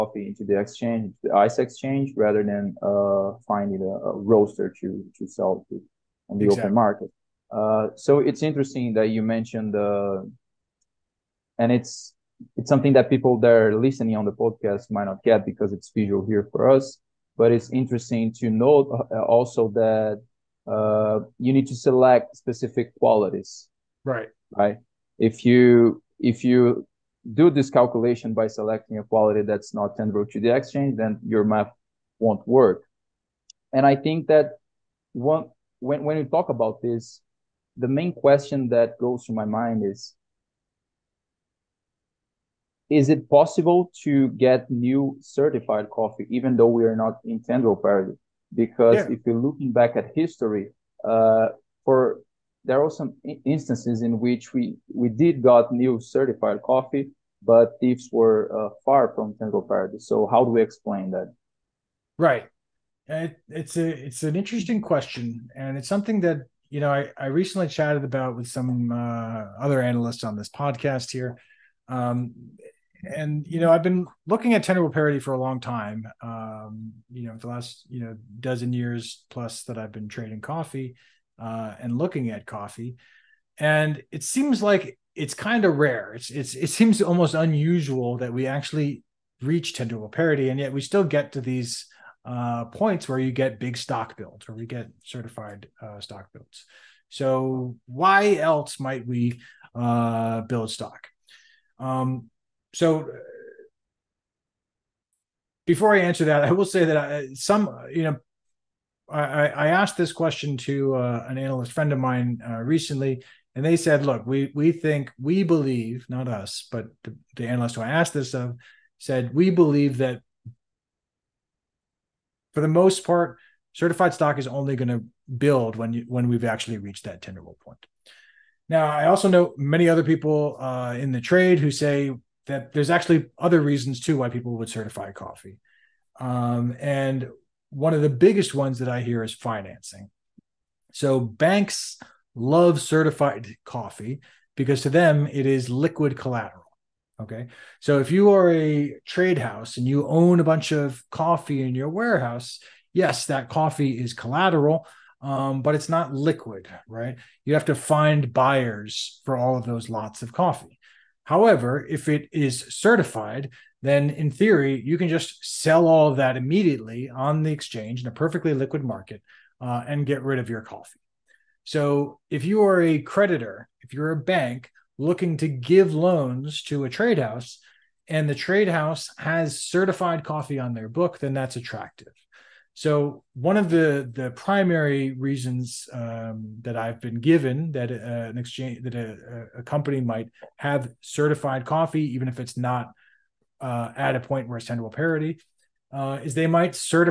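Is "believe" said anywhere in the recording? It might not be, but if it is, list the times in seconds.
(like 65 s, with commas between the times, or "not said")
115 s, 119 s.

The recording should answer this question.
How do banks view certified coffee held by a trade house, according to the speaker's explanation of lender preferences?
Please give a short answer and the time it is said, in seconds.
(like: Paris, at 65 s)
Liquid collateral, at 145 s.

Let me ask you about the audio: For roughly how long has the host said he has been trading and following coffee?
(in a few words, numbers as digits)
dozen years plus.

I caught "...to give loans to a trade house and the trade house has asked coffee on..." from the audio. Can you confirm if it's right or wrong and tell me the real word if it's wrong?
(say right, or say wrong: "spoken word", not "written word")
wrong: "certified", not "asked".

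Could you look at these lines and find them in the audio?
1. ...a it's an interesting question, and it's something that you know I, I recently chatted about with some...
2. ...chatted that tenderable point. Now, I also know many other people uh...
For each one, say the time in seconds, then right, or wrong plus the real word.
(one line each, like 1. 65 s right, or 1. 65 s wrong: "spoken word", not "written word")
1. 63 s right
2. 126 s wrong: "reached", not "chatted".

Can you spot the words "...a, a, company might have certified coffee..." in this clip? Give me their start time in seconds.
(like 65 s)
188 s.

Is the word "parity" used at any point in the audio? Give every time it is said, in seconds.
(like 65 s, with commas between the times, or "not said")
47 s, 59 s, 74 s, 90 s, 194 s.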